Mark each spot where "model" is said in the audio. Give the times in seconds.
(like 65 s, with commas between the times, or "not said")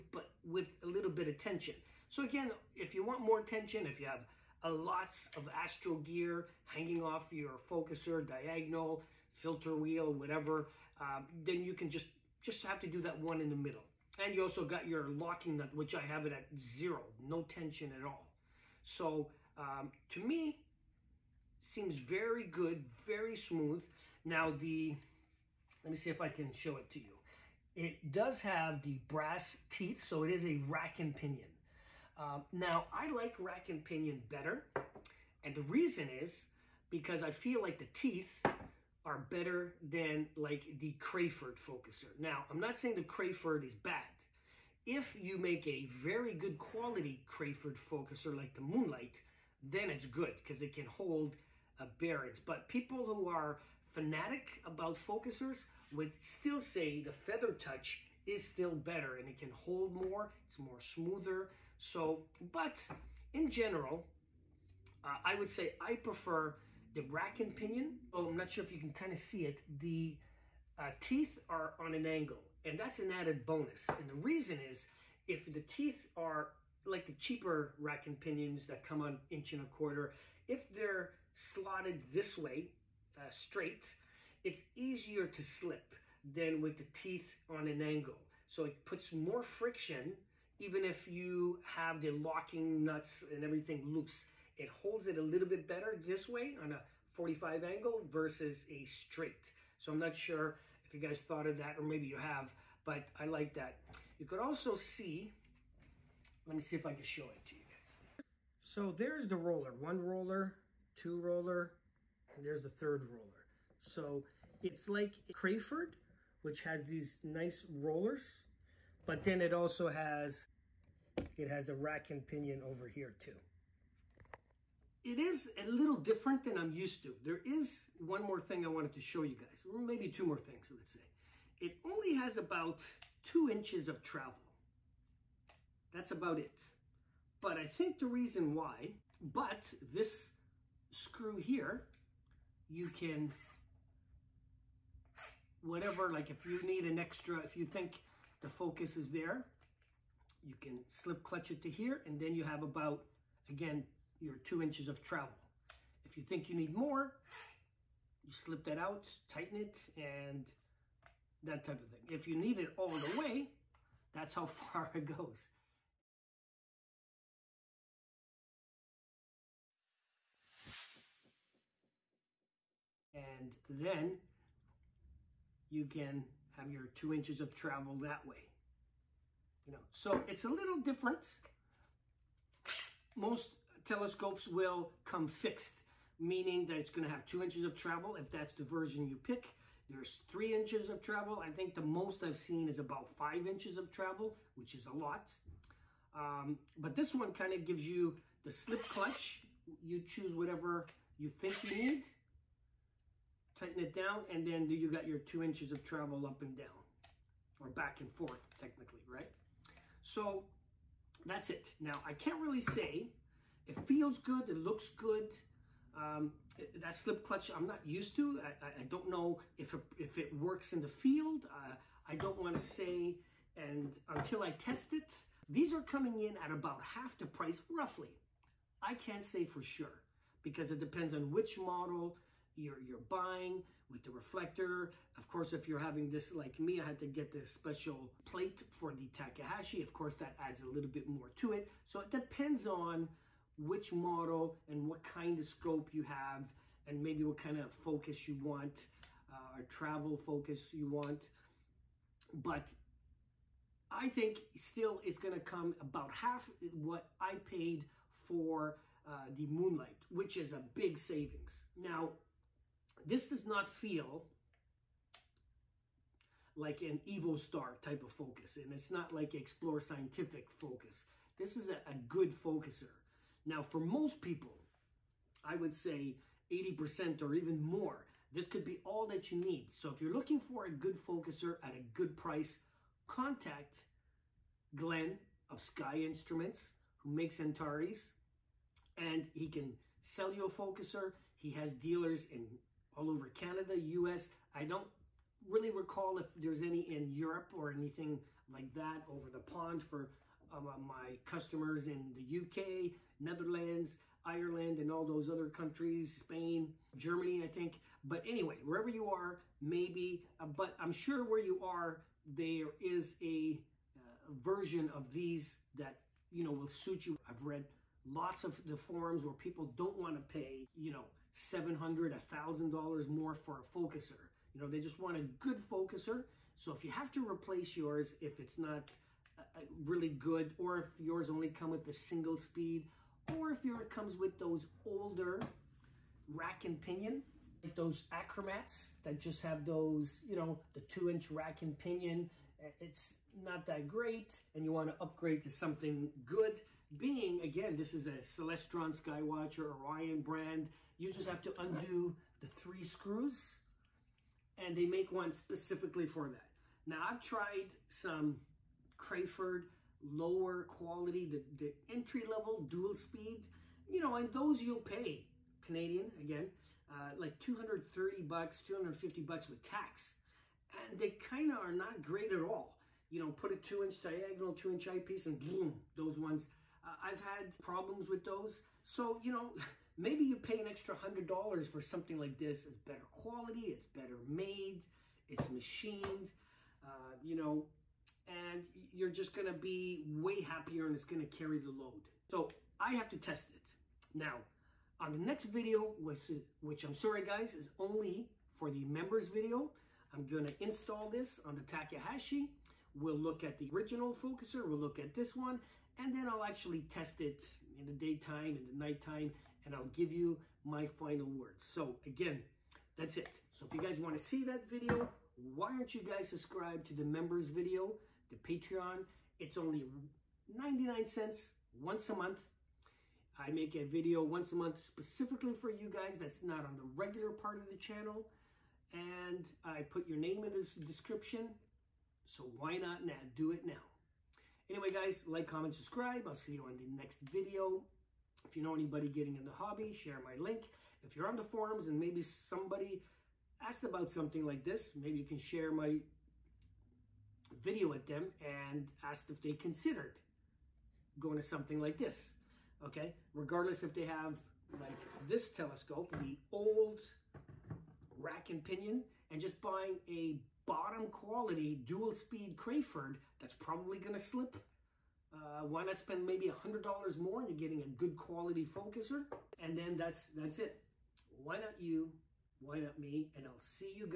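231 s, 243 s.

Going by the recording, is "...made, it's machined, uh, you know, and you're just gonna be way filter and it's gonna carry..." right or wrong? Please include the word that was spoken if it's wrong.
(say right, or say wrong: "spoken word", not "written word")
wrong: "happier", not "filter".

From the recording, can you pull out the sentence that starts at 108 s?
So there's the roller, one roller, two roller, and there's the third roller.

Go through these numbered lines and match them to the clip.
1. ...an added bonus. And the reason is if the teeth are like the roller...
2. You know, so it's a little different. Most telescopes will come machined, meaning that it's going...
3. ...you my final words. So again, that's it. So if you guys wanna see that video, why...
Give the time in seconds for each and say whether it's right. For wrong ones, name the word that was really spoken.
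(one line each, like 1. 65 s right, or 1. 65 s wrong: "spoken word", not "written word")
1. 72 s wrong: "cheaper", not "roller"
2. 179 s wrong: "fixed", not "machined"
3. 410 s right.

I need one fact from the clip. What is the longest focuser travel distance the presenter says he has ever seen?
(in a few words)
5 inches.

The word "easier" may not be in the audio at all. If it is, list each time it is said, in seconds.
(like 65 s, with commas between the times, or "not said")
84 s.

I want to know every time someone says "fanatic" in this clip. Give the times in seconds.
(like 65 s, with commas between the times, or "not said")
53 s.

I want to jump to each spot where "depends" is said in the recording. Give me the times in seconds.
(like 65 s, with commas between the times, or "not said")
230 s, 242 s.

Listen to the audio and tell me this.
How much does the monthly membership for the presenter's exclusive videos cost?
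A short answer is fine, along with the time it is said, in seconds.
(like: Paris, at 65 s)
99 cents, at 420 s.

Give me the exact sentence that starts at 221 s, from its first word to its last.
Uh, I don't want to say, and until I test it, these are coming in at about half the price, roughly.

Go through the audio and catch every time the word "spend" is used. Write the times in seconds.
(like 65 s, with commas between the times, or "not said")
465 s.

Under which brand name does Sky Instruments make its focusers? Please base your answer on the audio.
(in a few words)
Antares.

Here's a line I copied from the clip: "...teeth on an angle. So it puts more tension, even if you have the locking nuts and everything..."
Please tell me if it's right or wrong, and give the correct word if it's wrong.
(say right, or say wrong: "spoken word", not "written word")
wrong: "friction", not "tension".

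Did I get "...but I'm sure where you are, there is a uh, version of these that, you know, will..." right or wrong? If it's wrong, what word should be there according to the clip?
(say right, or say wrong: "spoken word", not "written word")
right.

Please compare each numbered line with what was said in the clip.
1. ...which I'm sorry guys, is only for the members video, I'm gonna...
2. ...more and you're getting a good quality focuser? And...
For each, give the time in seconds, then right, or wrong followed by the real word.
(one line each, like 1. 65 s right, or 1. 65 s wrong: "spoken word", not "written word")
1. 396 s right
2. 467 s right.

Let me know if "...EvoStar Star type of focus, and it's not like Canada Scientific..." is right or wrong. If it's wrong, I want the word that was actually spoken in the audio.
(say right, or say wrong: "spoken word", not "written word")
wrong: "Explore", not "Canada".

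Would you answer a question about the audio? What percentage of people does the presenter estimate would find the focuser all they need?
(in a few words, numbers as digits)
80%.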